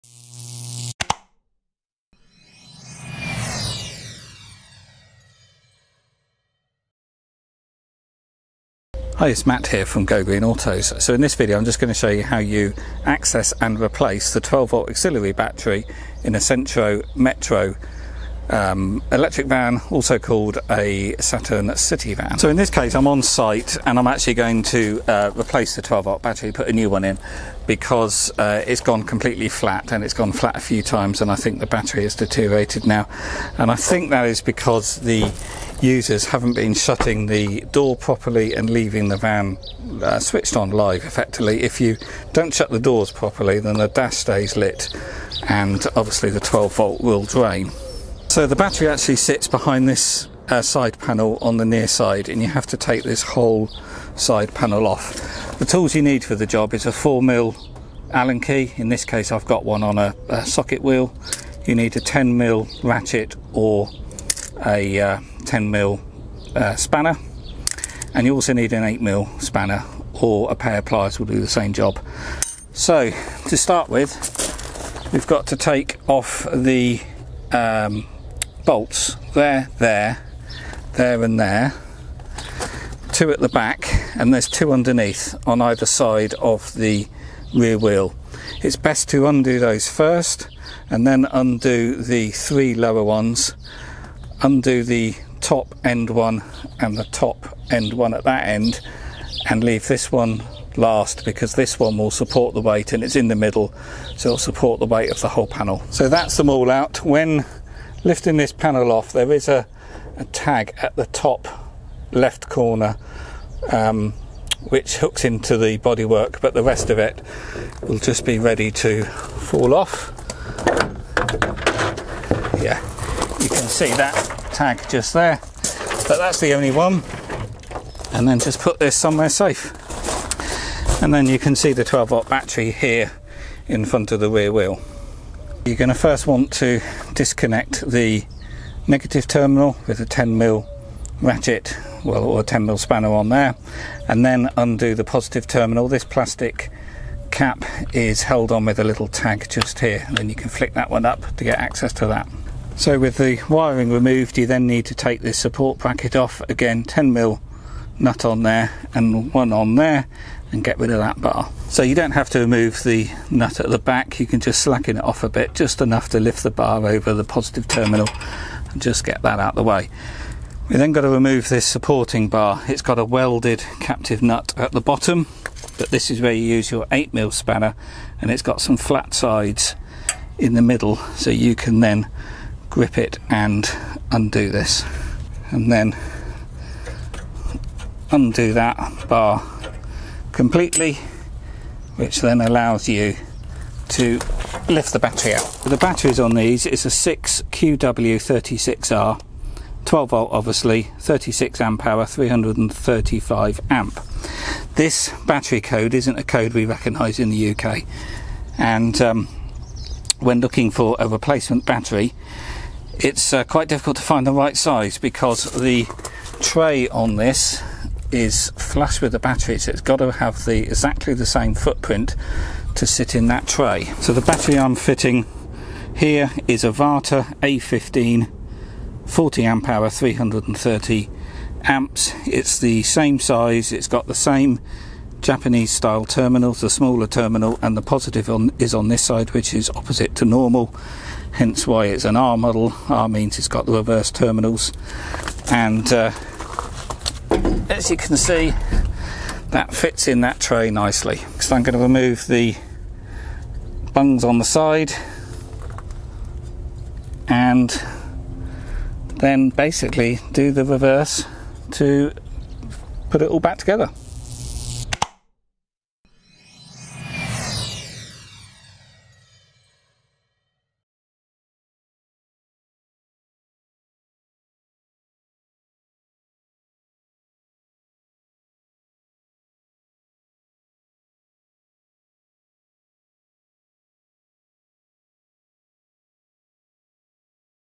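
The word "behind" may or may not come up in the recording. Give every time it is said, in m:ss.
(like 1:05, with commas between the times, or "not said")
0:49.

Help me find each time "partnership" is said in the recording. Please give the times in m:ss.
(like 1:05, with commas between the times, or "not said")
not said.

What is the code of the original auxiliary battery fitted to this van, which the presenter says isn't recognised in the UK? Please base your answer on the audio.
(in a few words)
6QW36R.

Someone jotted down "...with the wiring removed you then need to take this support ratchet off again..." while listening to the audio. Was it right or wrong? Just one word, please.
wrong.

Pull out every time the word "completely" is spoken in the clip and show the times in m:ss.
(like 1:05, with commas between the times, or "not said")
0:29, 3:10.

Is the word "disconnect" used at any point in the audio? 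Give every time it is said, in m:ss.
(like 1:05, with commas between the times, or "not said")
2:17.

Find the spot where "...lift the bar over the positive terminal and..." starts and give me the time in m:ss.
2:46.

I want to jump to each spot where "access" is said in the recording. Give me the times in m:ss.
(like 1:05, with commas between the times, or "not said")
0:13, 2:31.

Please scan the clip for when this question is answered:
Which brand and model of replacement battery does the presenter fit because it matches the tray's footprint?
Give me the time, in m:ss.
3:46.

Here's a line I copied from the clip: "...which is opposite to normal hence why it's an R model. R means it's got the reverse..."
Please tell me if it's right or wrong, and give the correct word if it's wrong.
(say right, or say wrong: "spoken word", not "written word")
right.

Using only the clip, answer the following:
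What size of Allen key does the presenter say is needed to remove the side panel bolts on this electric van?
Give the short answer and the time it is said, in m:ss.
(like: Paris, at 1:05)
4mm, at 0:56.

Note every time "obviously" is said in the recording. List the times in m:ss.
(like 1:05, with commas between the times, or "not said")
0:45, 3:20.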